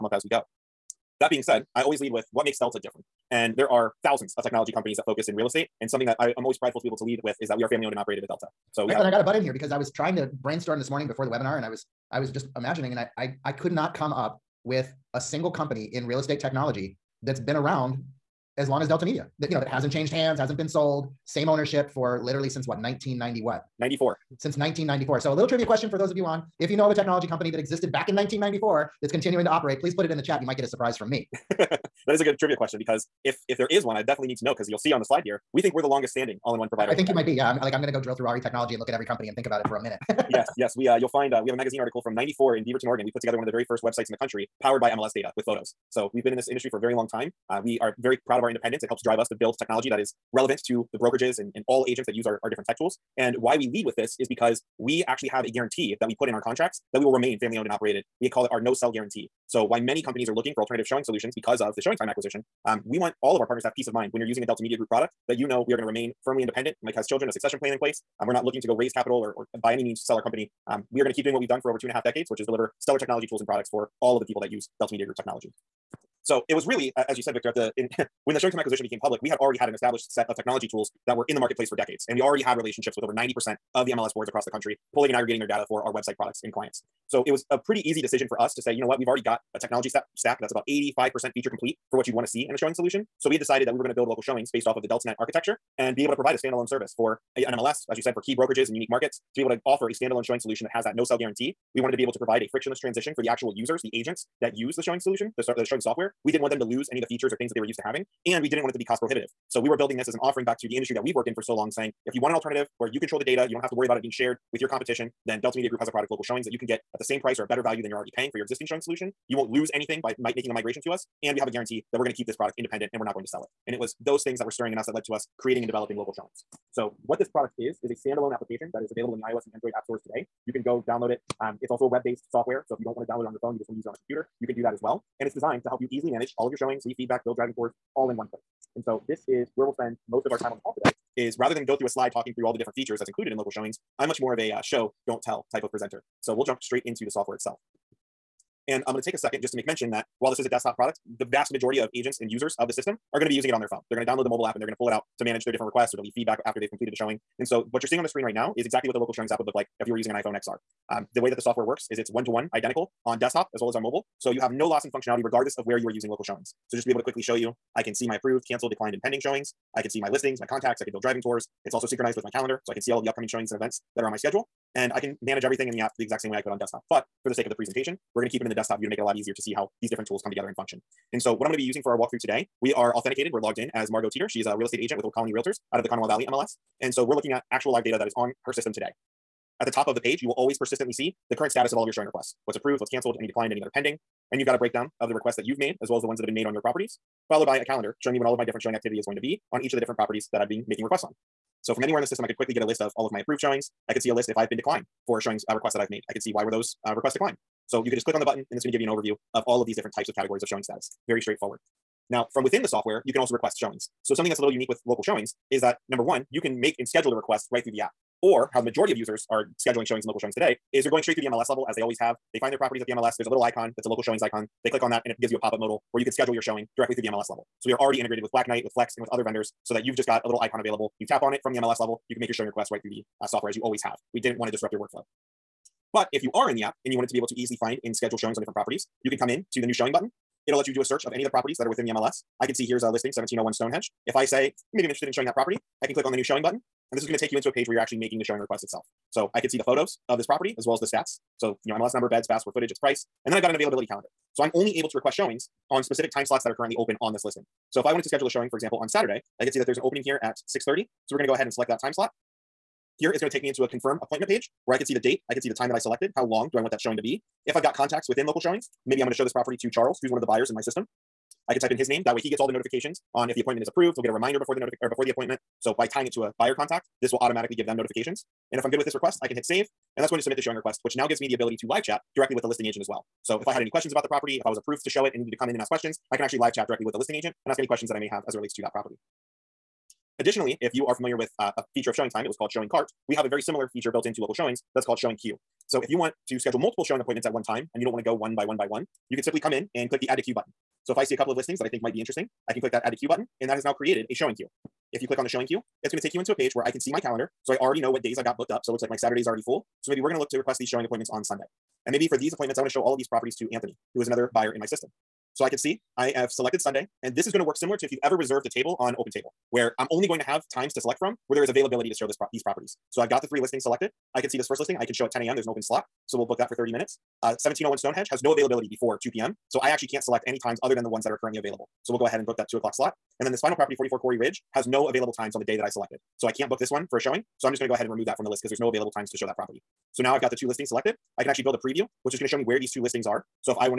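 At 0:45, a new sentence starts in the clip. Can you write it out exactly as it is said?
So we've been in this industry for a very long time.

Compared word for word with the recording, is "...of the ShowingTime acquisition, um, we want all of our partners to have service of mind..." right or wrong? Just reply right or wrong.
wrong.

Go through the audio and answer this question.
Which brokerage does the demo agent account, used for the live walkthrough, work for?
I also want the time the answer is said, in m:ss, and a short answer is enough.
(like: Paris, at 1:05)
Old Colony Realtors, at 3:05.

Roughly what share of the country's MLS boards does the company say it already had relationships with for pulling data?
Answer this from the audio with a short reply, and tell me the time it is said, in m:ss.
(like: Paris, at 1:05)
Over 90%, at 1:23.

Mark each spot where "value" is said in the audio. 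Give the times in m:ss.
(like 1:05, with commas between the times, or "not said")
1:57.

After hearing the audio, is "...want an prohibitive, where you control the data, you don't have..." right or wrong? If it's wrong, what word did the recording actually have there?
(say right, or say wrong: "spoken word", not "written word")
wrong: "alternative", not "prohibitive".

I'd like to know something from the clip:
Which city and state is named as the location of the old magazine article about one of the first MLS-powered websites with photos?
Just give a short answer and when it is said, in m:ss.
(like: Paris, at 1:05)
Beaverton, Oregon, at 0:42.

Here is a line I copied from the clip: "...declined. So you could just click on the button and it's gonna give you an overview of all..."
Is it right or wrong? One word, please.
right.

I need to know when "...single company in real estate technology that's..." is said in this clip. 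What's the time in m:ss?
0:15.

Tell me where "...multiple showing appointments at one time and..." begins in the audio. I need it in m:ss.
4:56.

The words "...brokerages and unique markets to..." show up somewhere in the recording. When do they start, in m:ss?
1:38.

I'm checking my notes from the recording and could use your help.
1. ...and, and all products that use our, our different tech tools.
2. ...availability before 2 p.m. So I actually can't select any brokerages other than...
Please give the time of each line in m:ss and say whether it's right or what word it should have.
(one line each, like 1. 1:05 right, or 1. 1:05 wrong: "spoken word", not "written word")
1. 0:51 wrong: "agents", not "products"
2. 5:28 wrong: "times", not "brokerages".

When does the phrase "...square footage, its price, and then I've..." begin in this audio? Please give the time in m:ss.
4:12.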